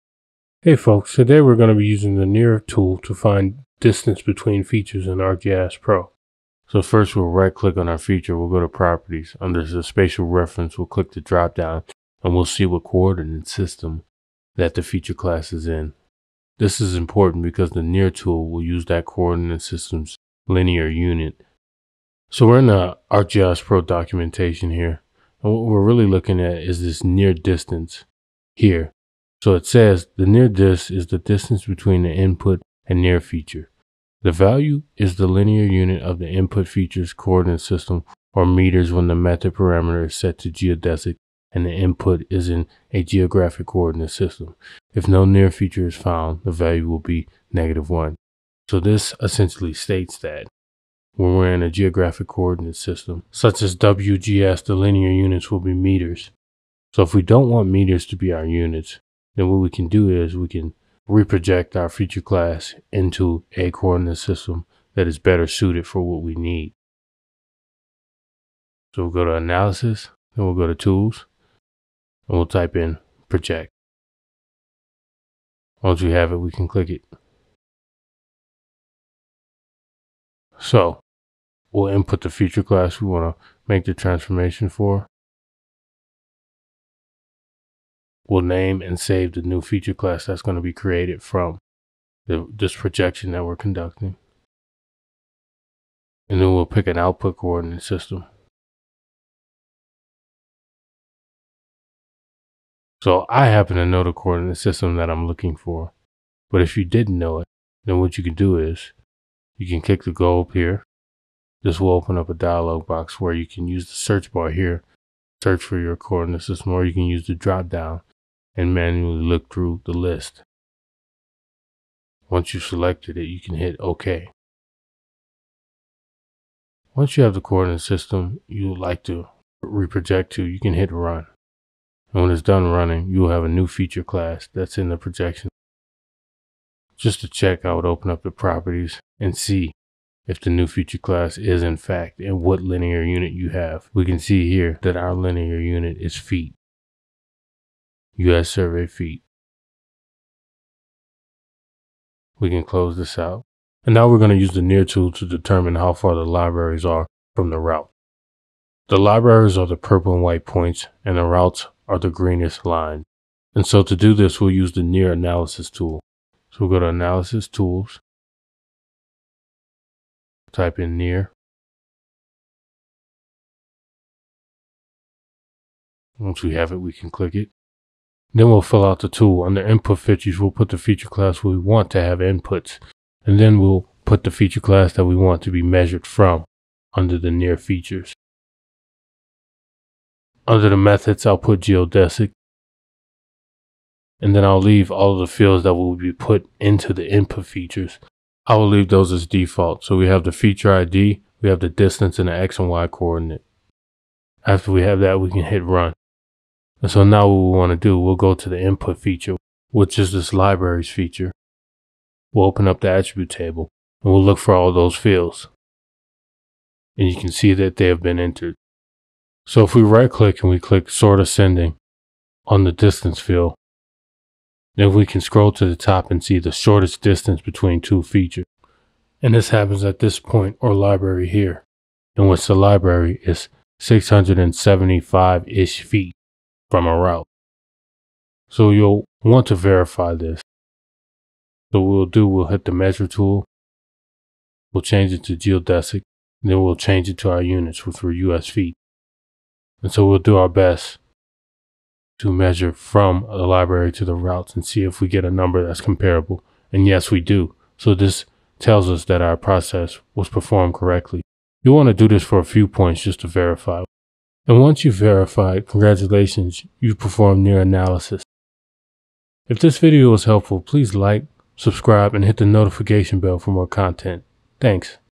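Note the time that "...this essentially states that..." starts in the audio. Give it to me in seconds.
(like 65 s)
48 s.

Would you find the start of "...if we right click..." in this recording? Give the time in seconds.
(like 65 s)
219 s.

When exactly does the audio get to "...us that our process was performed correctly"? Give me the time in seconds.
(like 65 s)
258 s.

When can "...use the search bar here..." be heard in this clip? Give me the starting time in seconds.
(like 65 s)
113 s.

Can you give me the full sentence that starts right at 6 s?
So first we'll right click on our feature, we'll go to properties.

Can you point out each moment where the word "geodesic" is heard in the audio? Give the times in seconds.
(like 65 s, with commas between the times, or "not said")
40 s, 191 s, 245 s.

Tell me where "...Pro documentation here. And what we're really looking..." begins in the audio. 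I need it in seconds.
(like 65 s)
23 s.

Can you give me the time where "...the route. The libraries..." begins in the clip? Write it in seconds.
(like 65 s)
157 s.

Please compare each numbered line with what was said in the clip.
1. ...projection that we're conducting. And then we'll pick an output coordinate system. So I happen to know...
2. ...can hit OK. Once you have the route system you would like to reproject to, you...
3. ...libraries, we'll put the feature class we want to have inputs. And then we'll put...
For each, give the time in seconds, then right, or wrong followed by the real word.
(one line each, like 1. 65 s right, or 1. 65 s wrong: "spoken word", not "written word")
1. 92 s right
2. 123 s wrong: "coordinate", not "route"
3. 179 s wrong: "features", not "libraries".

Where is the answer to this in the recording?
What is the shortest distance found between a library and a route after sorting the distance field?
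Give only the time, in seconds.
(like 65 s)
233 s.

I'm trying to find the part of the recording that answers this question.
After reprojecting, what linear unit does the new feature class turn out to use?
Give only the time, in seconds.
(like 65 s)
148 s.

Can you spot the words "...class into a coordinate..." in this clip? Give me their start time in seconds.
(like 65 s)
62 s.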